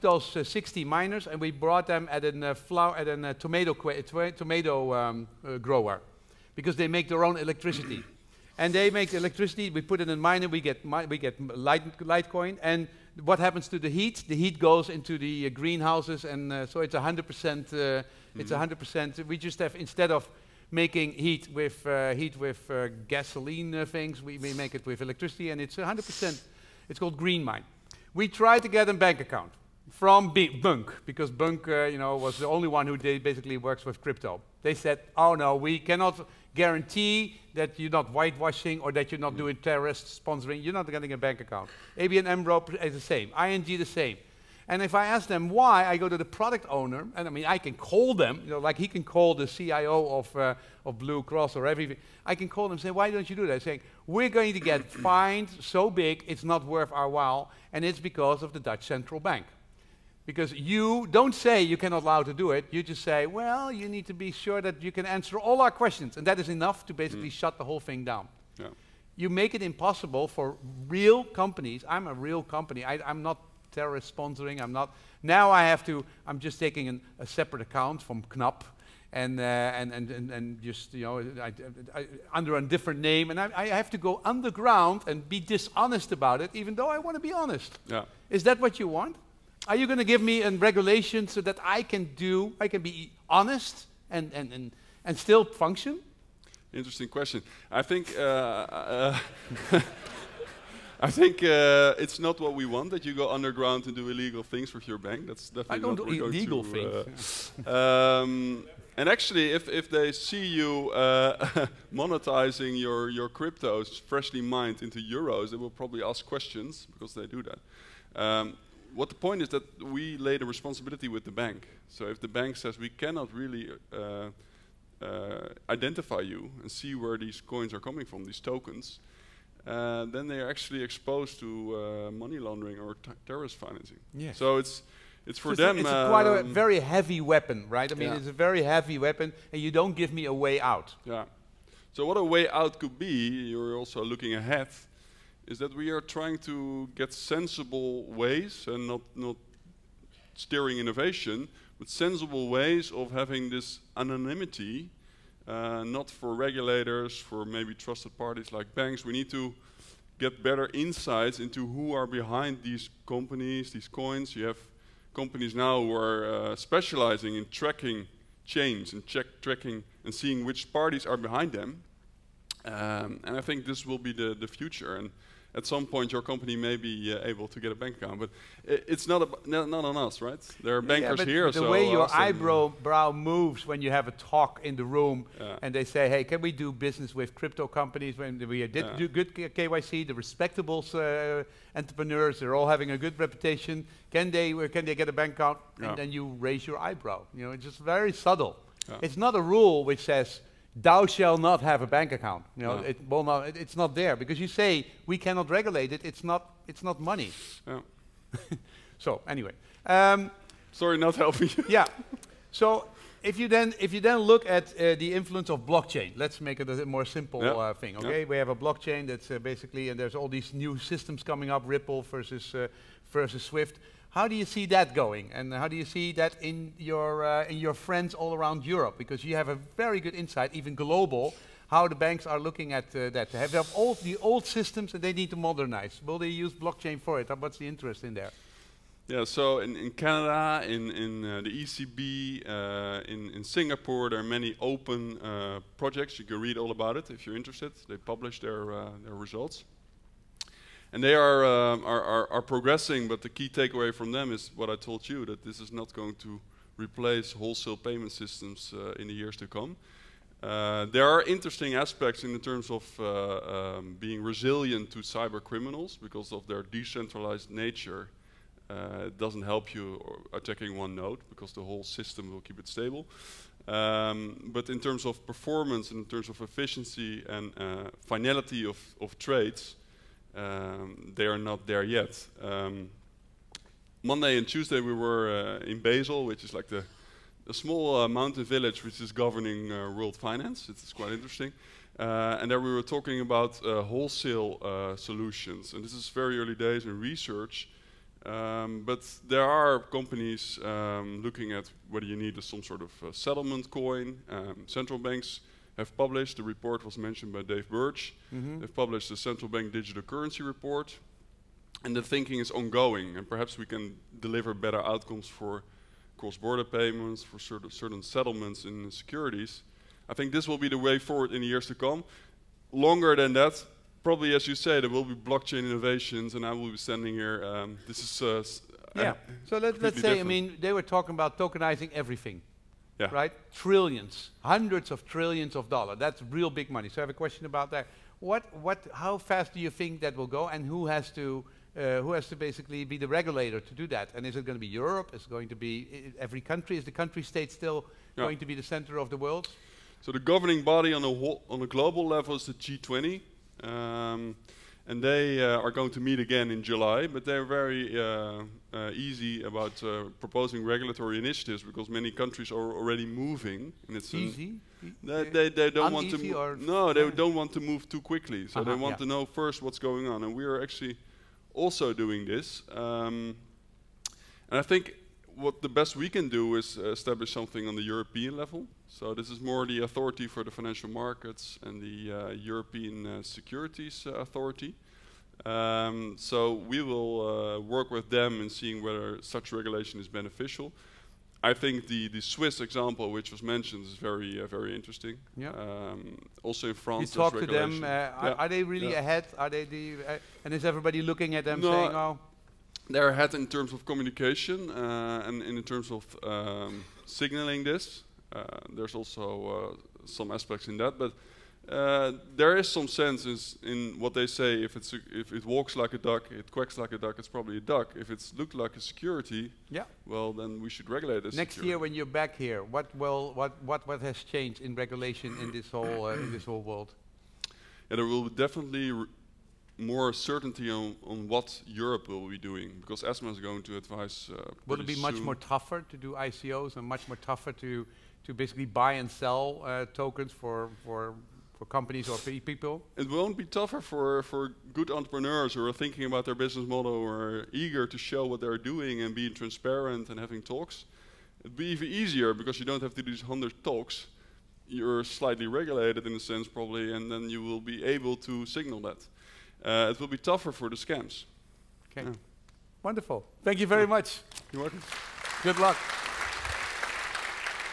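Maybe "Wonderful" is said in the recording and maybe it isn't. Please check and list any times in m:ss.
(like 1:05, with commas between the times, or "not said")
7:42.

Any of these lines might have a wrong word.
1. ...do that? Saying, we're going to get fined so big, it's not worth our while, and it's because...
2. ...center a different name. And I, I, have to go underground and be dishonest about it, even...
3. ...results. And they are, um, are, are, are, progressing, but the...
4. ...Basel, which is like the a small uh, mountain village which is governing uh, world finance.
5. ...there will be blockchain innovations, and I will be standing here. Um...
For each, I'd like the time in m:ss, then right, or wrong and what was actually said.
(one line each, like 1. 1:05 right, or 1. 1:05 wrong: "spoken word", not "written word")
1. 0:53 right
2. 1:22 wrong: "under", not "center"
3. 4:09 right
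4. 4:45 right
5. 5:24 right.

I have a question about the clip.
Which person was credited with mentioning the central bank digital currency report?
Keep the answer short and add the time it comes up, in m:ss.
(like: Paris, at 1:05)
Dave Birch, at 5:07.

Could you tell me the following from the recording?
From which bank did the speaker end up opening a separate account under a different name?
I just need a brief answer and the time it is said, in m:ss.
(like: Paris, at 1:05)
Knab, at 1:18.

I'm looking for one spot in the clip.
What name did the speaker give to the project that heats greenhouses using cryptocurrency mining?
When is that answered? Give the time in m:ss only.
0:27.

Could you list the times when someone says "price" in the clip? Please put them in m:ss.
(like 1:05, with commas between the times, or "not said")
not said.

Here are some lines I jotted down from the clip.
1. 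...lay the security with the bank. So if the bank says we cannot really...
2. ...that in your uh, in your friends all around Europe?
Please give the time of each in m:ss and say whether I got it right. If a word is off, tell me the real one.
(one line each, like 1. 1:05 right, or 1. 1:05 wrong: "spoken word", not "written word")
1. 2:00 wrong: "responsibility", not "security"
2. 3:46 right.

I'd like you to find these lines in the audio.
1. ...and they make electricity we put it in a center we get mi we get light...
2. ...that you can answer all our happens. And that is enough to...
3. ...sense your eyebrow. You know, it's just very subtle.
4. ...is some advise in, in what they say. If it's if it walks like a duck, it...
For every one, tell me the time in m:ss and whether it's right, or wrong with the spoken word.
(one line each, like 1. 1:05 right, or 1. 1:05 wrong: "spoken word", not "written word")
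1. 0:08 wrong: "miner", not "center"
2. 1:04 wrong: "questions", not "happens"
3. 3:16 wrong: "raise", not "sense"
4. 6:52 wrong: "sense", not "advise".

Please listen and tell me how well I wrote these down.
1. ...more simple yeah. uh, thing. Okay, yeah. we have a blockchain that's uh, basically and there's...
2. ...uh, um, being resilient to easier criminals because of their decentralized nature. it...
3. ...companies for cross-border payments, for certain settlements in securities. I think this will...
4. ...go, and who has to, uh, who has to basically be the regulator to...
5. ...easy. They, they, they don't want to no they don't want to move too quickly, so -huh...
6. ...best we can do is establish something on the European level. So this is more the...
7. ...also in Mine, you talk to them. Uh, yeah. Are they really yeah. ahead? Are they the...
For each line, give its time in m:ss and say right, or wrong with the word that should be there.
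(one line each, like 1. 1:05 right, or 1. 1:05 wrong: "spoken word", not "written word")
1. 3:36 right
2. 4:22 wrong: "cyber", not "easier"
3. 5:14 wrong: "outcomes", not "companies"
4. 5:40 right
5. 6:04 right
6. 6:15 right
7. 6:36 wrong: "France", not "Mine".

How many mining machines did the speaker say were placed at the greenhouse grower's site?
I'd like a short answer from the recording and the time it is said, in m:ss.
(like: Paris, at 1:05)
60, at 0:00.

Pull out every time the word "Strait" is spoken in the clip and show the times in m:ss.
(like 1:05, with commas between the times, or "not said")
not said.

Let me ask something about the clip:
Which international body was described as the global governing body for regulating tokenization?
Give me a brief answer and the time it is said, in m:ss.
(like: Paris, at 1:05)
G20, at 5:52.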